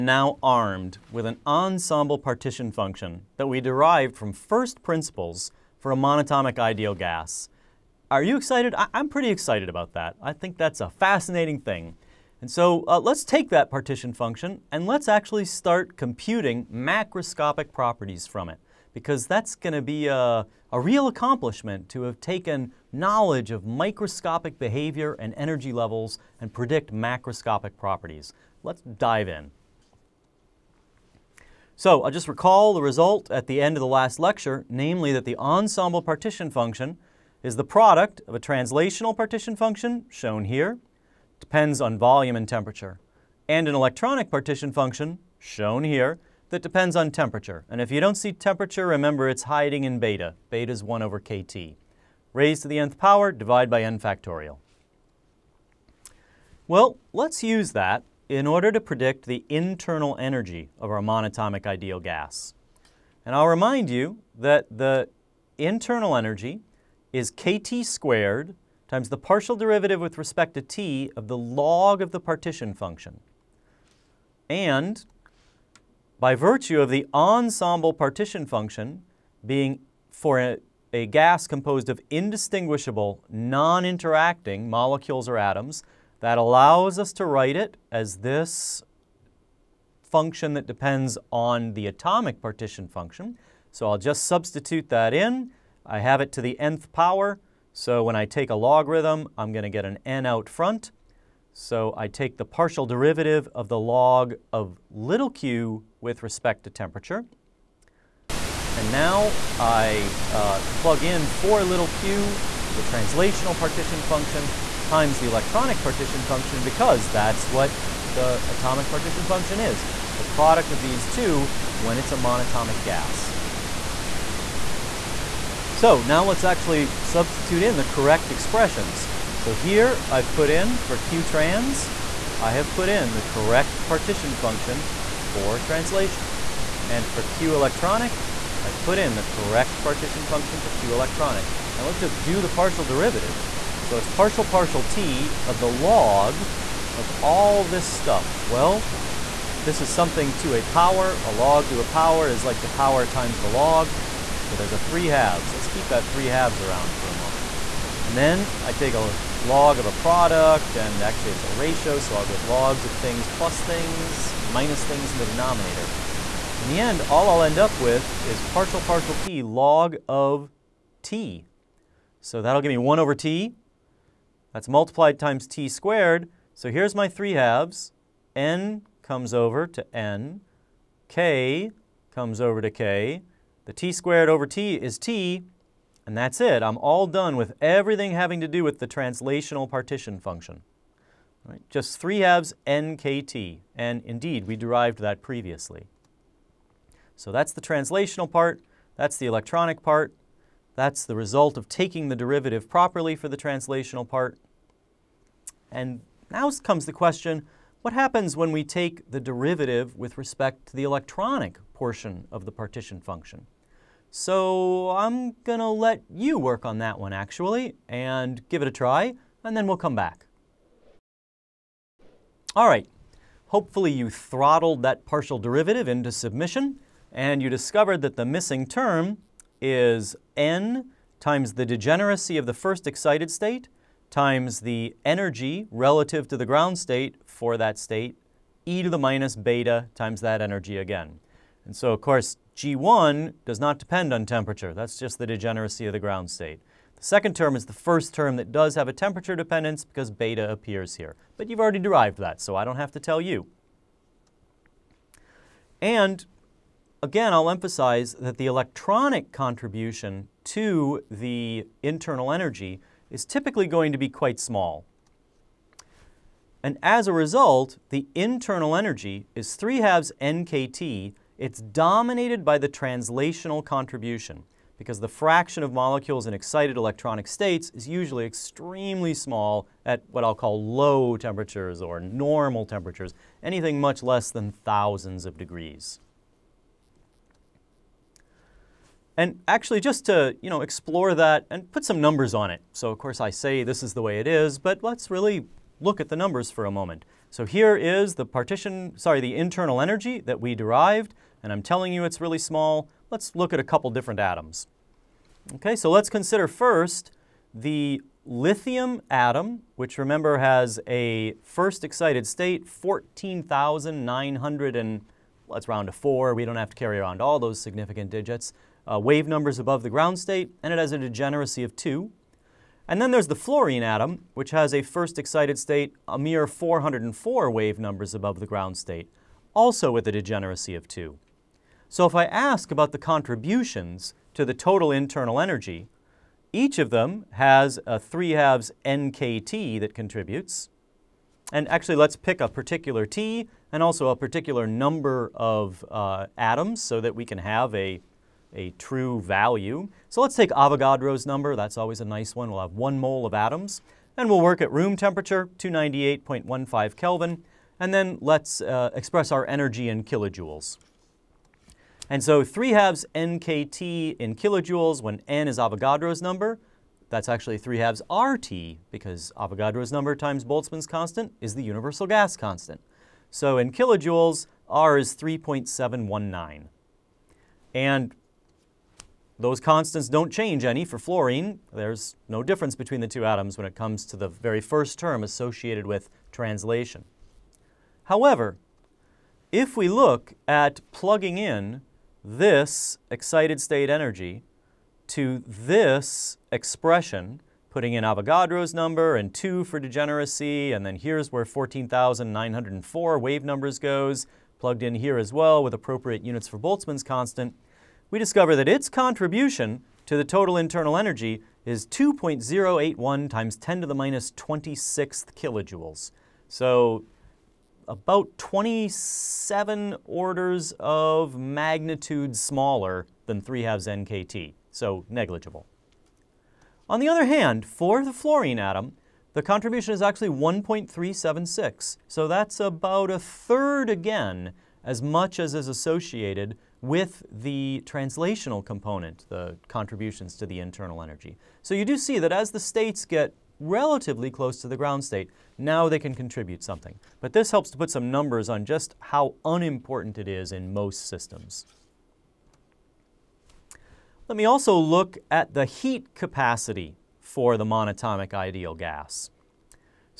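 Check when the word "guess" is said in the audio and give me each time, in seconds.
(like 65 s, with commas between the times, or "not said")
not said.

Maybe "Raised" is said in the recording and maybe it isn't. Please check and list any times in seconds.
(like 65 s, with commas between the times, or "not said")
52 s.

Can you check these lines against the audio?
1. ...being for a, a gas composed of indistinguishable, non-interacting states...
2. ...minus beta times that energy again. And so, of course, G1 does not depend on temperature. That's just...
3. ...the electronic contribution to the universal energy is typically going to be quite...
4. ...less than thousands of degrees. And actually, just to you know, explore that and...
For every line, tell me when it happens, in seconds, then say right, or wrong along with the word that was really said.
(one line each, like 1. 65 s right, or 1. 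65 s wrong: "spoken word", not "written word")
1. 79 s wrong: "molecules", not "states"
2. 238 s right
3. 258 s wrong: "internal", not "universal"
4. 284 s right.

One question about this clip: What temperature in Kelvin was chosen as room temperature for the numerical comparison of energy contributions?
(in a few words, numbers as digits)
298.15 Kelvin.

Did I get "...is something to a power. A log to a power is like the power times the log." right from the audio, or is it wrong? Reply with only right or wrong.
right.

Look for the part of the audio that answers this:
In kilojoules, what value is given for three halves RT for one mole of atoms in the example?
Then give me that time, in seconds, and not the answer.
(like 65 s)
375 s.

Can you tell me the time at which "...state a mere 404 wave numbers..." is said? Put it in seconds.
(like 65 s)
325 s.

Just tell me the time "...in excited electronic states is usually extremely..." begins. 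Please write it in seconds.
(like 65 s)
276 s.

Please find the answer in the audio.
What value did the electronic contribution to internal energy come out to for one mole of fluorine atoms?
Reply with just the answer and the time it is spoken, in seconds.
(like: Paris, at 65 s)
1.376, at 430 s.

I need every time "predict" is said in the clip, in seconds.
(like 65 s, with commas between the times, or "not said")
26 s, 58 s.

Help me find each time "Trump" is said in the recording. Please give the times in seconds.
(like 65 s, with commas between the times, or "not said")
not said.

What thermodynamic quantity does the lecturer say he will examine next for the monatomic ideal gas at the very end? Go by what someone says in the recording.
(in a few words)
heat capacity.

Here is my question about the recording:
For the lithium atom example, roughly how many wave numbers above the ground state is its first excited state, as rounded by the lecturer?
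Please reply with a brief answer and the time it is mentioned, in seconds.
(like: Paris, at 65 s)
14,904, at 401 s.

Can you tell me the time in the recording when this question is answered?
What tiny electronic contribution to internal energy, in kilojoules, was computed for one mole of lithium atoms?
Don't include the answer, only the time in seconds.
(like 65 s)
411 s.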